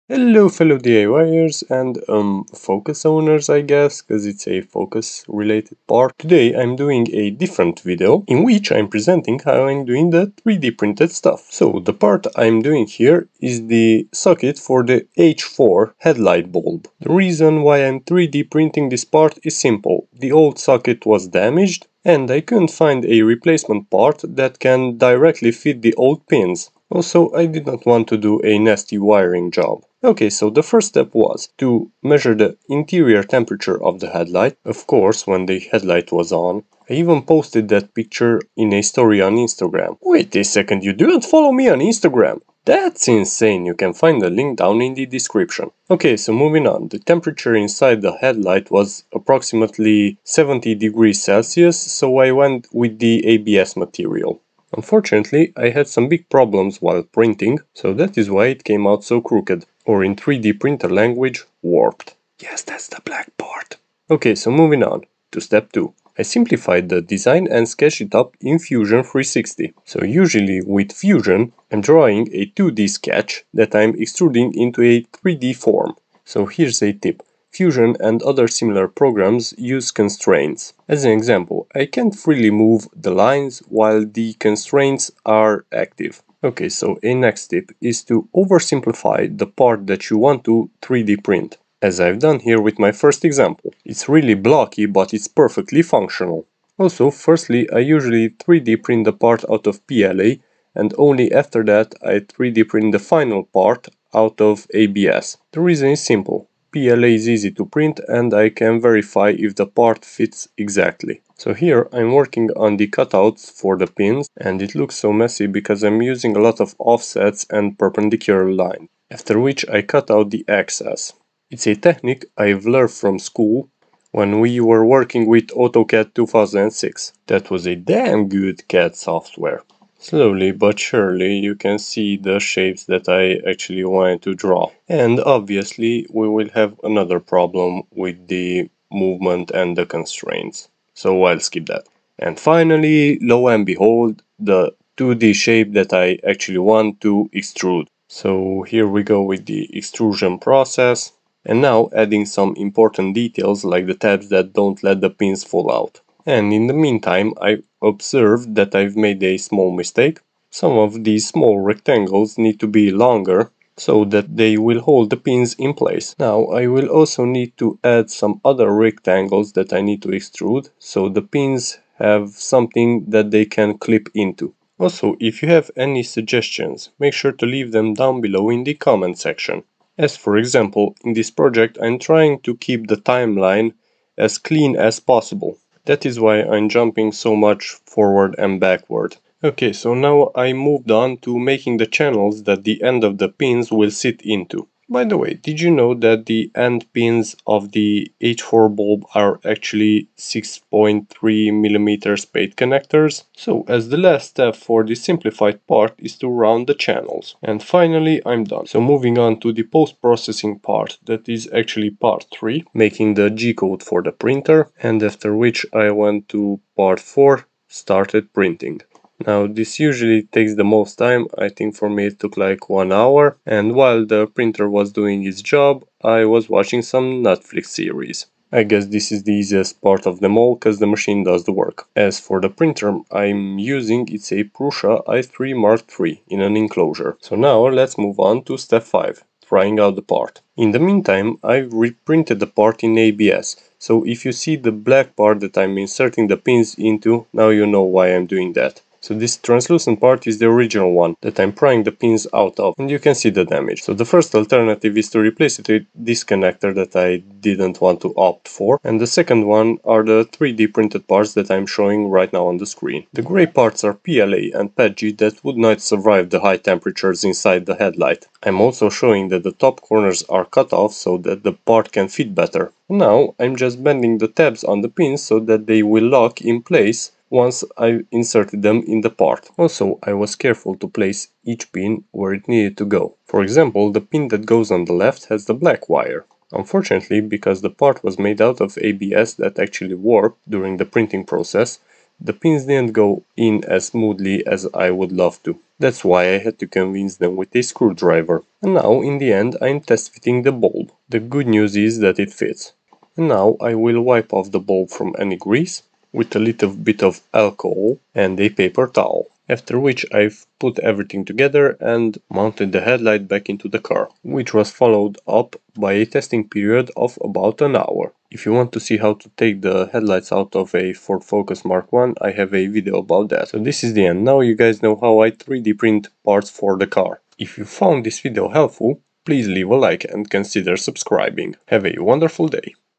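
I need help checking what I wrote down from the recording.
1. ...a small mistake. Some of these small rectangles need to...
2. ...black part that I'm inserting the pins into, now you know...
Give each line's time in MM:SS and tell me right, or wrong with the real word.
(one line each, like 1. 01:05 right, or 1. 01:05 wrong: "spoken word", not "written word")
1. 02:39 right
2. 04:04 right.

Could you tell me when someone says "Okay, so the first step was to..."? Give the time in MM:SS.
00:30.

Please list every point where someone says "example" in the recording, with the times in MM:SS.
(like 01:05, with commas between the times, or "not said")
01:21, 01:33, 03:00, 04:43.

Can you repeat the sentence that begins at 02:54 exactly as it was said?
Also, if you have any suggestions, make sure to leave them down below in the comment section.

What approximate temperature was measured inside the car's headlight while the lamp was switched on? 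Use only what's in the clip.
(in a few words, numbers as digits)
70 degrees Celsius.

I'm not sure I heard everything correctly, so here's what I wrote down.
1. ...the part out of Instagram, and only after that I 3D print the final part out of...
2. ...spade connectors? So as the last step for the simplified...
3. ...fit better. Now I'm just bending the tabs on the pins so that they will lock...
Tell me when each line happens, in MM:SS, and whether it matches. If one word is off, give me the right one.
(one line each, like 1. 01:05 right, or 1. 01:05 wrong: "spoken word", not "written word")
1. 01:39 wrong: "PLA", not "Instagram"
2. 03:22 right
3. 04:32 right.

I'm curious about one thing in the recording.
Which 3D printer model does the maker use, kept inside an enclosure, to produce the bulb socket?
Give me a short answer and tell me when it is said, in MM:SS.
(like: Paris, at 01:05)
Prusa i3 Mark III, at 03:54.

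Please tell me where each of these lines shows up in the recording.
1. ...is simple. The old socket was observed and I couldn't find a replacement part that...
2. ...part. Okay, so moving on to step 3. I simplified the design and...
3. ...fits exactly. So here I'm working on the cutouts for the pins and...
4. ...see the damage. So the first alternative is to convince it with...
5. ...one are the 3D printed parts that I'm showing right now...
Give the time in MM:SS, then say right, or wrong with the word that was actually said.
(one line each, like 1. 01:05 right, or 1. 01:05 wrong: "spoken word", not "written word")
1. 00:19 wrong: "damaged", not "observed"
2. 01:03 wrong: "2", not "3"
3. 01:50 right
4. 04:13 wrong: "replace", not "convince"
5. 04:19 right.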